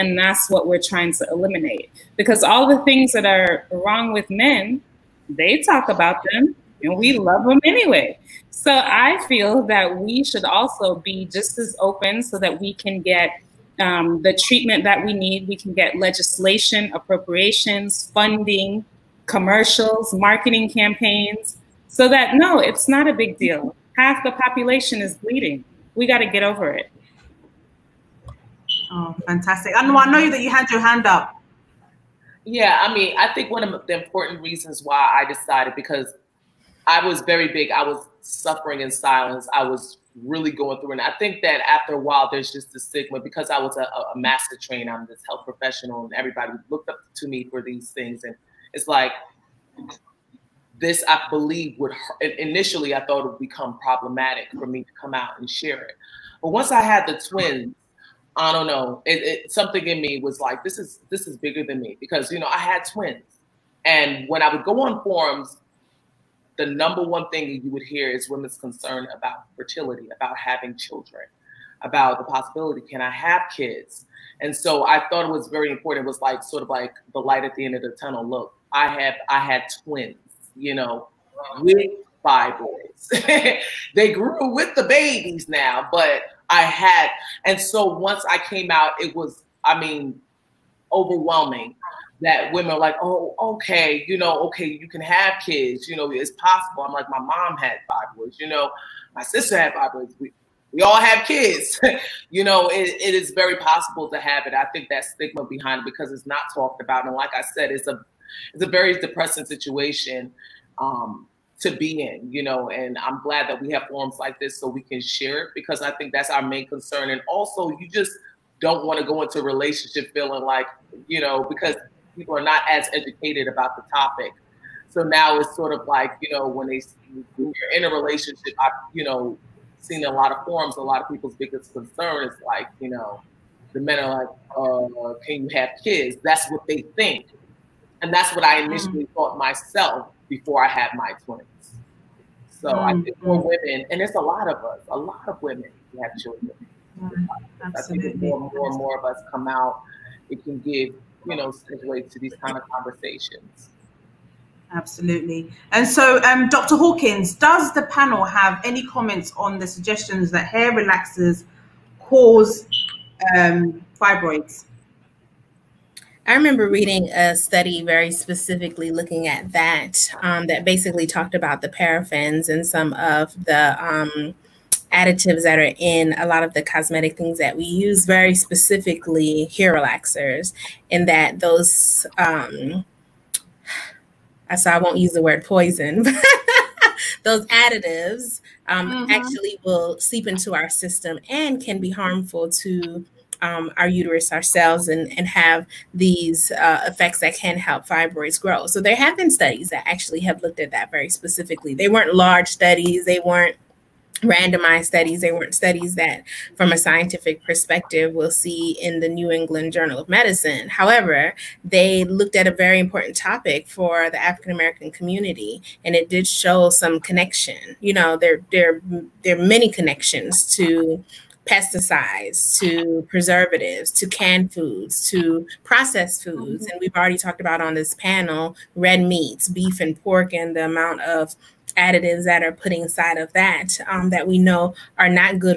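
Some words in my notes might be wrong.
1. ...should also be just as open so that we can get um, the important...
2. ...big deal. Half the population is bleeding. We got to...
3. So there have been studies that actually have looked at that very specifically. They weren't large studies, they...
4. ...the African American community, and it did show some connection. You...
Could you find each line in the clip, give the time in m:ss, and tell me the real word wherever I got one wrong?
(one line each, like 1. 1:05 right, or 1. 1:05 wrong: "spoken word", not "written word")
1. 0:10 wrong: "treatment", not "important"
2. 0:23 right
3. 3:18 right
4. 3:34 right.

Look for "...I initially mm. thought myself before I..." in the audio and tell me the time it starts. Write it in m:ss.
2:18.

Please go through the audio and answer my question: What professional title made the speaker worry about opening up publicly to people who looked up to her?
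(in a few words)
master trainer.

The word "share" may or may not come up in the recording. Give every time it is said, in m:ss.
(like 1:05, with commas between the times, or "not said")
0:55, 1:55.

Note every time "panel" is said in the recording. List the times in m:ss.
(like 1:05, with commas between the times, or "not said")
2:37, 3:47.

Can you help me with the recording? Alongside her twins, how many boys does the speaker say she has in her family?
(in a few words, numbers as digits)
5.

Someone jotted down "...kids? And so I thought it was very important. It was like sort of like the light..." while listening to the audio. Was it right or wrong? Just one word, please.
right.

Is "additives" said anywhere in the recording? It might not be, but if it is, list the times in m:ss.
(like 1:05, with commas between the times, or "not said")
2:54, 3:07, 3:51.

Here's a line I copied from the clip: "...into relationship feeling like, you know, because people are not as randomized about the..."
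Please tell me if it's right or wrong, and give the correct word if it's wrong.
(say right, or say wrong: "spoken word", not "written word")
wrong: "educated", not "randomized".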